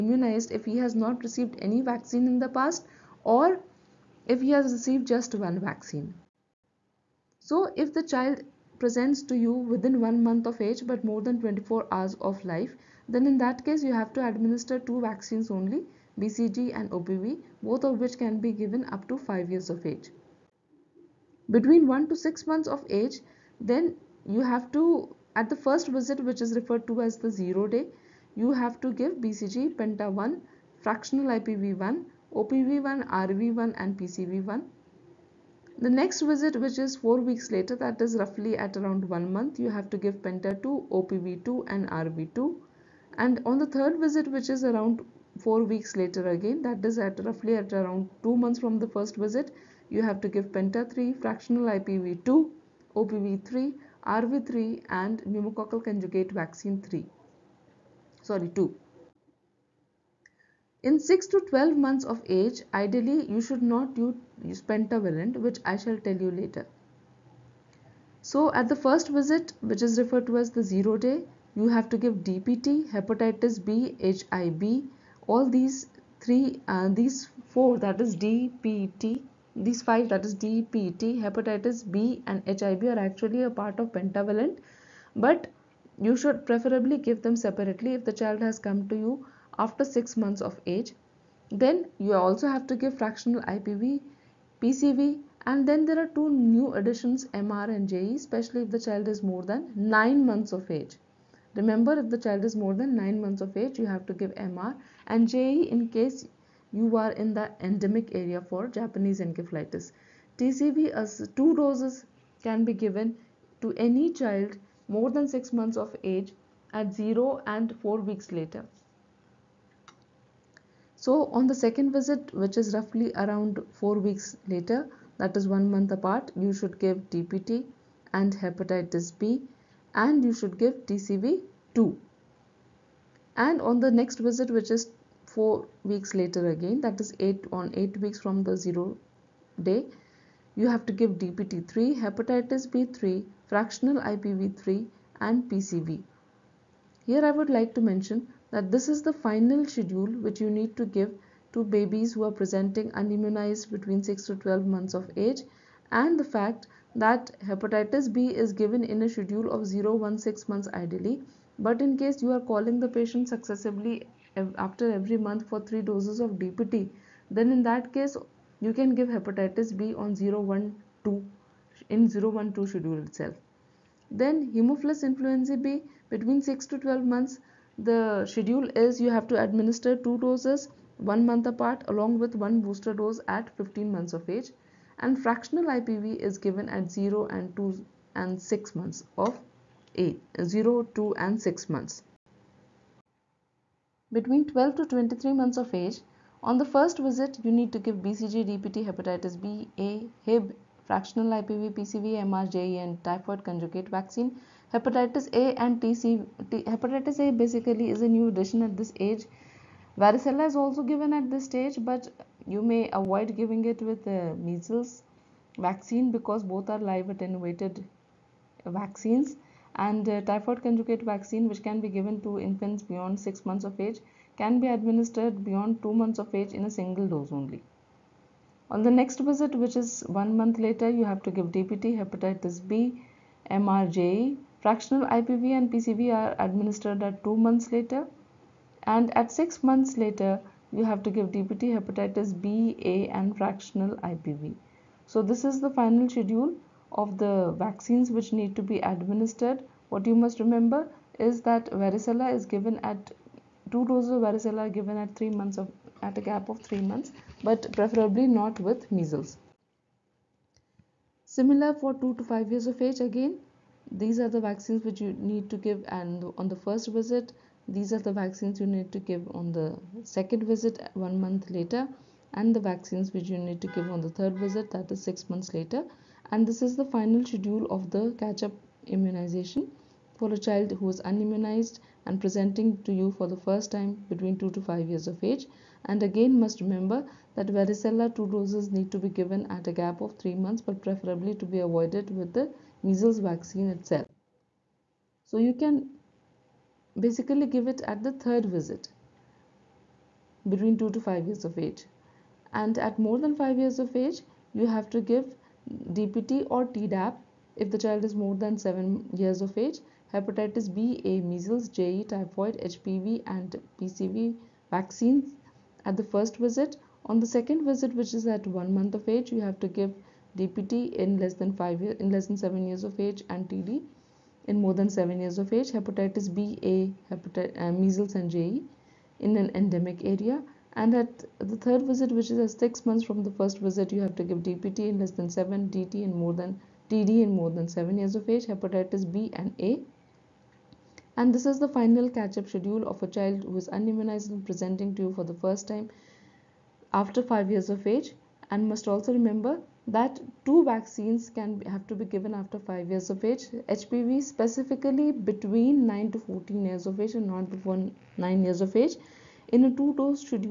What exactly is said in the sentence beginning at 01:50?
TCV as two doses can be given to any child more than 6 months of age at 0 and 4 weeks later.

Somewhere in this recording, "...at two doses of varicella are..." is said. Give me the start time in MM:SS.
04:12.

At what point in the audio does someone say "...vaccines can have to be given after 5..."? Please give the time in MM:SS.
05:50.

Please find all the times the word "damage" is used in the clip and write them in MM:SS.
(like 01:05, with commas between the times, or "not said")
not said.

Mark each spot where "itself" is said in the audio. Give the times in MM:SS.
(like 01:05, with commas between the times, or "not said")
02:53, 04:53.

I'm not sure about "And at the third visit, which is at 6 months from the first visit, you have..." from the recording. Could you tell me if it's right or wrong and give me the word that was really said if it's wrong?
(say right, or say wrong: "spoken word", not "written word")
right.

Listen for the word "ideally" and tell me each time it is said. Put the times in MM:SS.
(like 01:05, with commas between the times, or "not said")
01:02, 02:40.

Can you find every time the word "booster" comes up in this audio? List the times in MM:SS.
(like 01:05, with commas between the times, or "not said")
03:02.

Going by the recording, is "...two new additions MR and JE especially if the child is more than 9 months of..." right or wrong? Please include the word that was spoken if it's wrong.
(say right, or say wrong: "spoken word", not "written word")
right.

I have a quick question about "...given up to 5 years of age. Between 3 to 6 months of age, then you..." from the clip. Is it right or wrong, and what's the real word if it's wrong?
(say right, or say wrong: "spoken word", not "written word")
wrong: "1", not "3".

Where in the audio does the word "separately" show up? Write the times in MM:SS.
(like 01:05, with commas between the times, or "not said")
01:27.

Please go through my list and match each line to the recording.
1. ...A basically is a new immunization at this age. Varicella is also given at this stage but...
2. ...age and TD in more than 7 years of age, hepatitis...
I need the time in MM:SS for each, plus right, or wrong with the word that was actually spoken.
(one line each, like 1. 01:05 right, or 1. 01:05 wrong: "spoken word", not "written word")
1. 03:27 wrong: "addition", not "immunization"
2. 05:22 right.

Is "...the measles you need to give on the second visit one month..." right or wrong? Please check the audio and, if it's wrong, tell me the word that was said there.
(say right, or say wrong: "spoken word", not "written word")
wrong: "vaccines", not "measles".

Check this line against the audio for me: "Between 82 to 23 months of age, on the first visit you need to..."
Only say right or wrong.
wrong.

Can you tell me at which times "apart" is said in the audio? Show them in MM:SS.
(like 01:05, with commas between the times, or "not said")
02:05, 03:01.